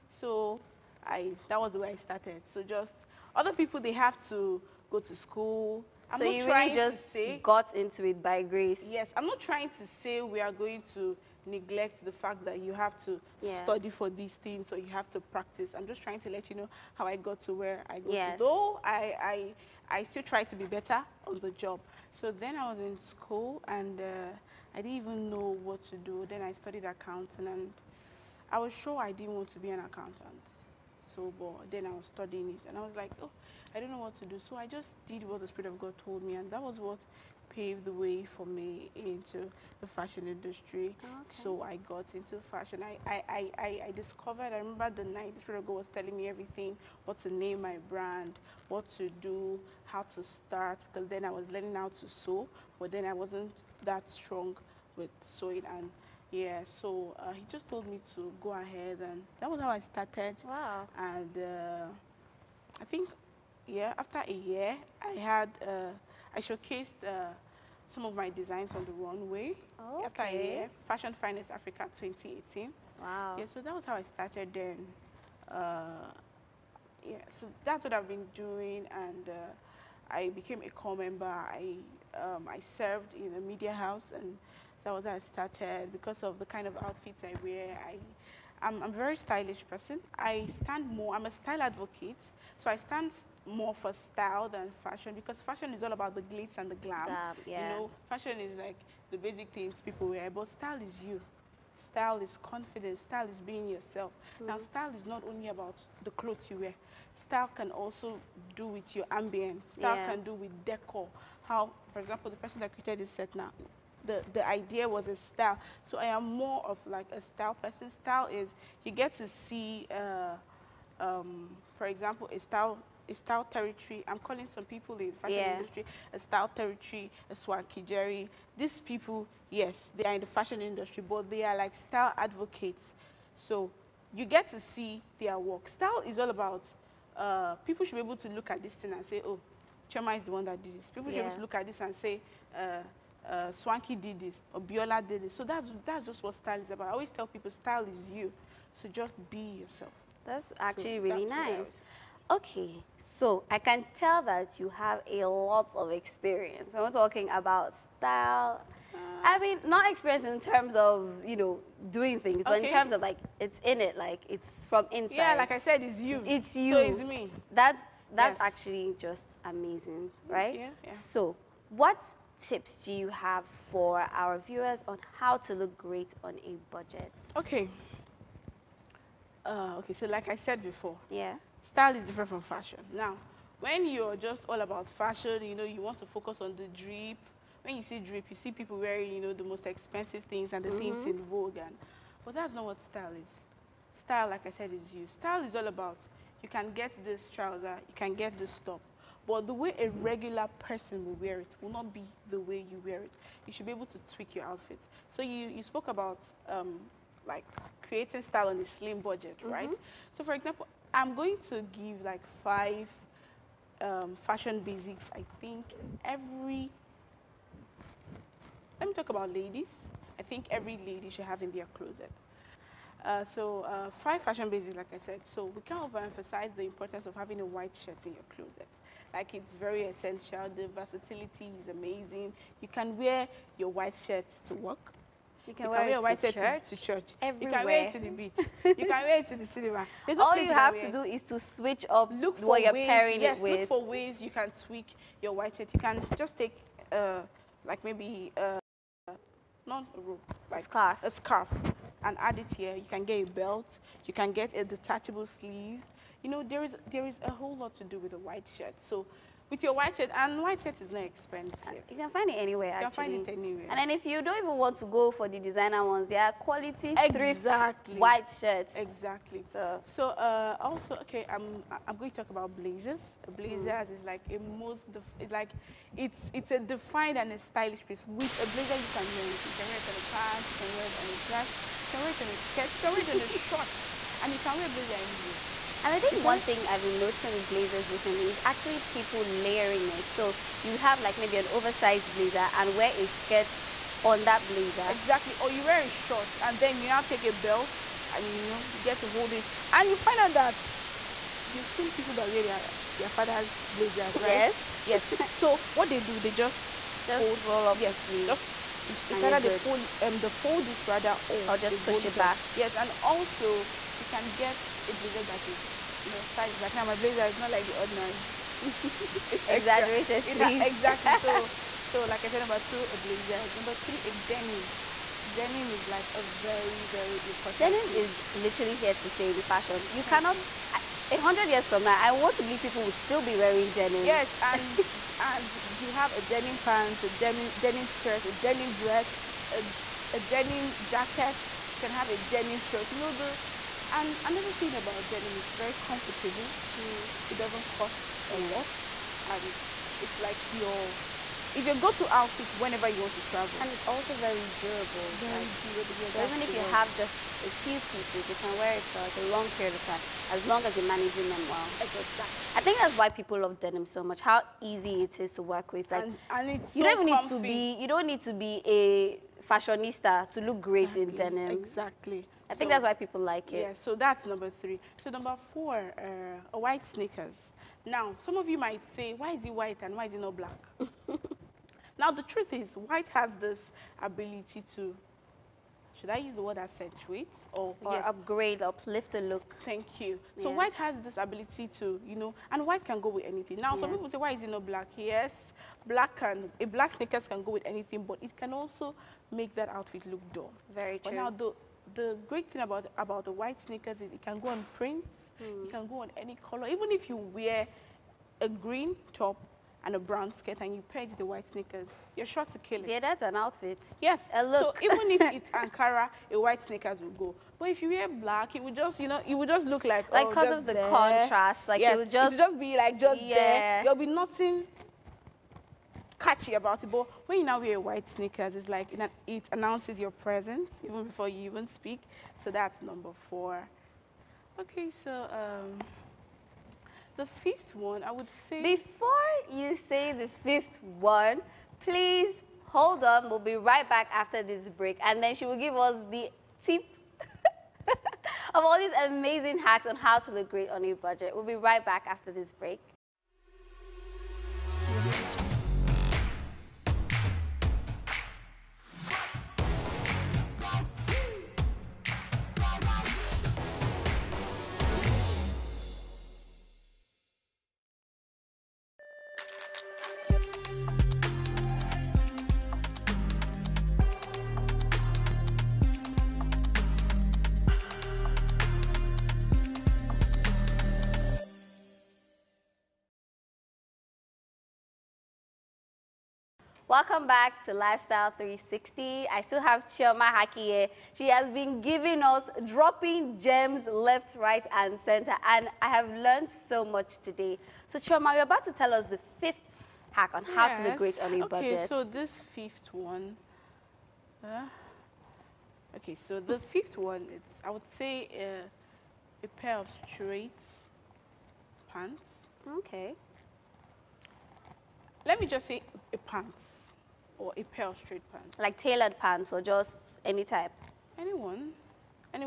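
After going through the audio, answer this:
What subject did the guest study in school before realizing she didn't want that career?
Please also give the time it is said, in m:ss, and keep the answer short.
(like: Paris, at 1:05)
Accounting, at 0:26.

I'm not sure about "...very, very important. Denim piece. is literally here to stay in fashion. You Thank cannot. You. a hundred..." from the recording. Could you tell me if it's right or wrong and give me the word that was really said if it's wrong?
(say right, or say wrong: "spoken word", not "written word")
right.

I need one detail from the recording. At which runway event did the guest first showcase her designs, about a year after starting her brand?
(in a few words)
Fashion Finest Africa 2018.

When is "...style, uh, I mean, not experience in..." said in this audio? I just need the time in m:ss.
2:37.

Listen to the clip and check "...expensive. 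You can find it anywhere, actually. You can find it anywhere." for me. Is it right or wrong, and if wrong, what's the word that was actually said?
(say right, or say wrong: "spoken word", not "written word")
right.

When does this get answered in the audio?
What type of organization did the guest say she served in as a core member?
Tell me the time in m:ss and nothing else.
1:23.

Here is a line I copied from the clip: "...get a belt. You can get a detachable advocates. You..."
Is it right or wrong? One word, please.
wrong.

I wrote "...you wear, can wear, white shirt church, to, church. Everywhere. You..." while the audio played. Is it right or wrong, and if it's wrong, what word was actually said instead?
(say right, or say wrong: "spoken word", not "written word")
right.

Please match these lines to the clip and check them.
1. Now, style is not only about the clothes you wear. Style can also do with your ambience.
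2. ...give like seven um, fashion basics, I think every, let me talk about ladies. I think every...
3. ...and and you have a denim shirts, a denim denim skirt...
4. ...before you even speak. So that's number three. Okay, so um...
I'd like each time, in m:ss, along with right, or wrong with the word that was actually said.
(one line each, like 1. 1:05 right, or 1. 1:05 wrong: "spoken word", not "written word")
1. 1:44 right
2. 3:31 wrong: "five", not "seven"
3. 5:34 wrong: "pants", not "shirts"
4. 7:11 wrong: "four", not "three".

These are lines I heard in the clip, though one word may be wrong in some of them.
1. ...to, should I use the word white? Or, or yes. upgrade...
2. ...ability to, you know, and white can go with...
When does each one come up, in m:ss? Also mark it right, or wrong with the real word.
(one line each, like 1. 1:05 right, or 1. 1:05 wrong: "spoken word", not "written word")
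1. 6:24 wrong: "accentuate", not "white"
2. 6:31 right.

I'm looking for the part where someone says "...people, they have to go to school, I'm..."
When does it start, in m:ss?
0:03.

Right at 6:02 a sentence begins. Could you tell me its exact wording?
So I think that's why people love denim so much, how easy it is to work with.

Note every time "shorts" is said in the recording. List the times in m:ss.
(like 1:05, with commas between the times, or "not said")
4:43, 4:55.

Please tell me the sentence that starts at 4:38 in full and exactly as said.
With a blazer, you can wear anything.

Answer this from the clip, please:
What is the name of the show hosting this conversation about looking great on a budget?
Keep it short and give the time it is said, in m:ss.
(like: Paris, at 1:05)
Lifestyle 360, at 8:07.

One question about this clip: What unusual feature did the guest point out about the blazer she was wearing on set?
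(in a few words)
Exaggerated sleeves.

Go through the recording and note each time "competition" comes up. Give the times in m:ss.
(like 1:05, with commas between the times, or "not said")
not said.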